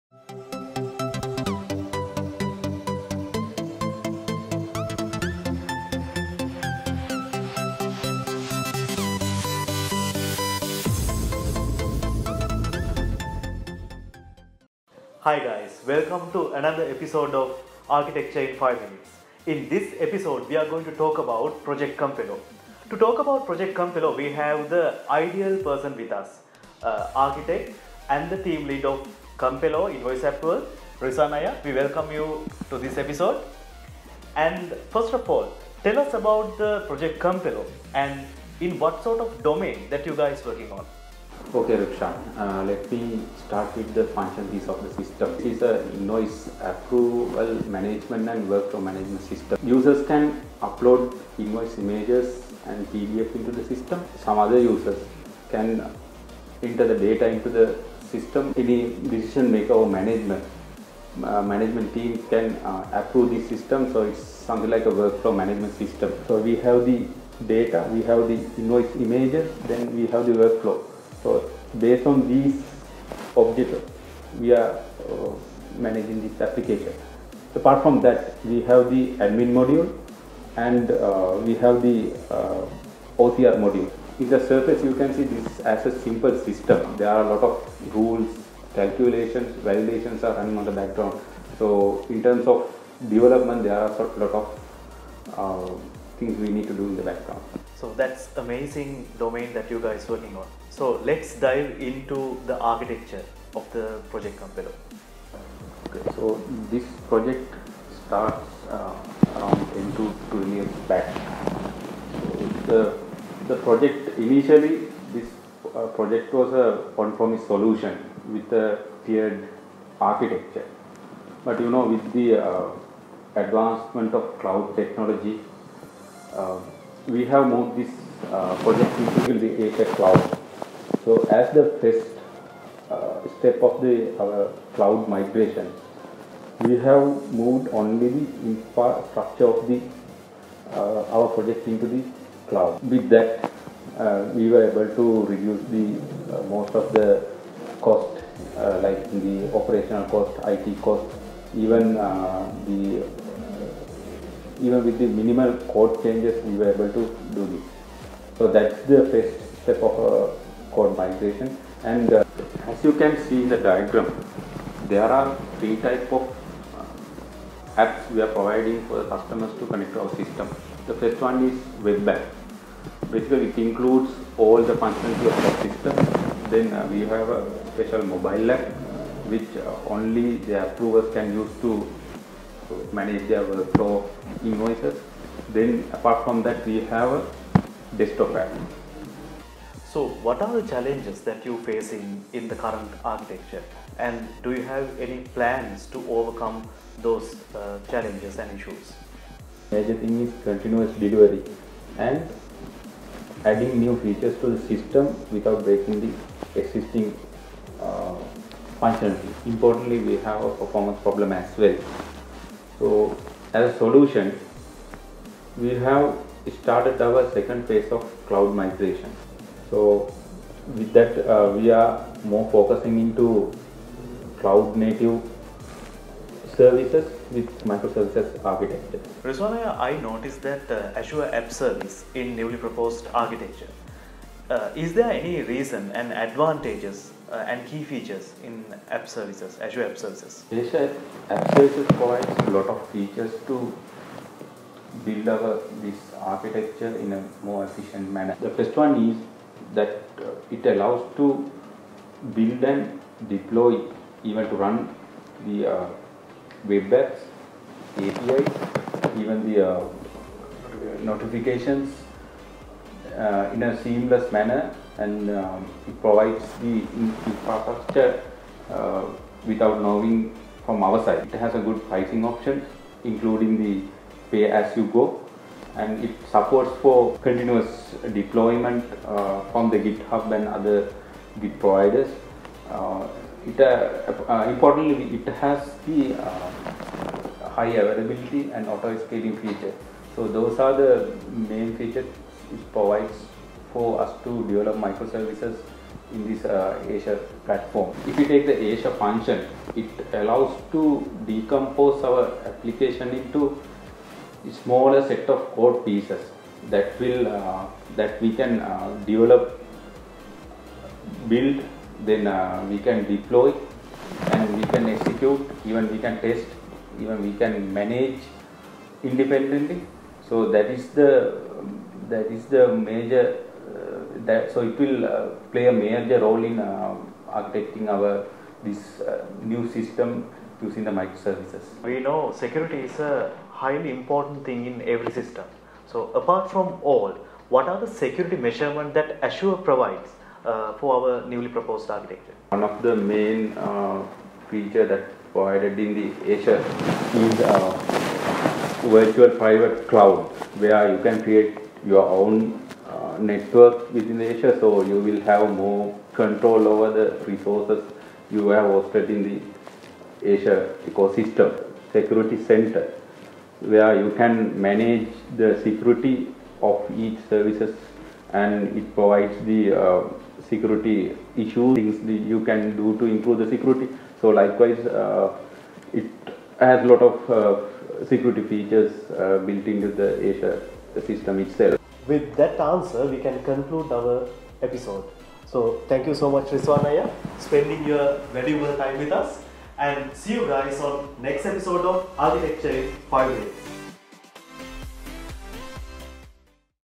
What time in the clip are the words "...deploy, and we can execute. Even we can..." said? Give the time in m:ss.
5:13.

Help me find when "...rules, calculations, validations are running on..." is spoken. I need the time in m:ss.
1:27.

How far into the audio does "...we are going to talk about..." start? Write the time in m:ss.
0:20.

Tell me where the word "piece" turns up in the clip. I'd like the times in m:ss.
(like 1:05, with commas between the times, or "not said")
0:44, 5:05.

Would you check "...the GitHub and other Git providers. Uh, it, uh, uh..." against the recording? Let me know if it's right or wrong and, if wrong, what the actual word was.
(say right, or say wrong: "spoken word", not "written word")
right.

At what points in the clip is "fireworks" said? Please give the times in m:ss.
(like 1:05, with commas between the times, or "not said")
not said.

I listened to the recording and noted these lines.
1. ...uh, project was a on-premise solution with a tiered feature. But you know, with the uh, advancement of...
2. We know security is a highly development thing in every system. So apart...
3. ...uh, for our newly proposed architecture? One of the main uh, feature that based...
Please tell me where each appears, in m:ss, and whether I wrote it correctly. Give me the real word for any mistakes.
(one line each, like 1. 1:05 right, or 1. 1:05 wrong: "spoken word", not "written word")
1. 1:55 wrong: "architecture", not "feature"
2. 5:31 wrong: "important", not "development"
3. 5:40 wrong: "provided", not "based".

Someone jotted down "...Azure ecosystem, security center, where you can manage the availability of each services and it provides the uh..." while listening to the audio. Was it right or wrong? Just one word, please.
wrong.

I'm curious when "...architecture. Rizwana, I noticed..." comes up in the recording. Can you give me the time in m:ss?
3:48.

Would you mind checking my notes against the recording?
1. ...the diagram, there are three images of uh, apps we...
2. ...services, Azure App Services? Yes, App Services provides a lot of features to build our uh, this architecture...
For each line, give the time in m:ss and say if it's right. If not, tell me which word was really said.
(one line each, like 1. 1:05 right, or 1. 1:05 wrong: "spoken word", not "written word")
1. 2:43 wrong: "types", not "images"
2. 3:59 right.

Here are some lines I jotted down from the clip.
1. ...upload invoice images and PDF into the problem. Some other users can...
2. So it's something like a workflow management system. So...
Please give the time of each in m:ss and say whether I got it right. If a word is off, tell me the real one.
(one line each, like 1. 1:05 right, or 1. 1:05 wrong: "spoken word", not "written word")
1. 0:50 wrong: "system", not "problem"
2. 1:03 right.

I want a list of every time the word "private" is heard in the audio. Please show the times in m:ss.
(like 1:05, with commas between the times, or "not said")
5:49.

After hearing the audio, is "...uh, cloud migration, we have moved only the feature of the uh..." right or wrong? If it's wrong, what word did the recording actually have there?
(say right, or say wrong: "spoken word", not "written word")
wrong: "infrastructure", not "feature".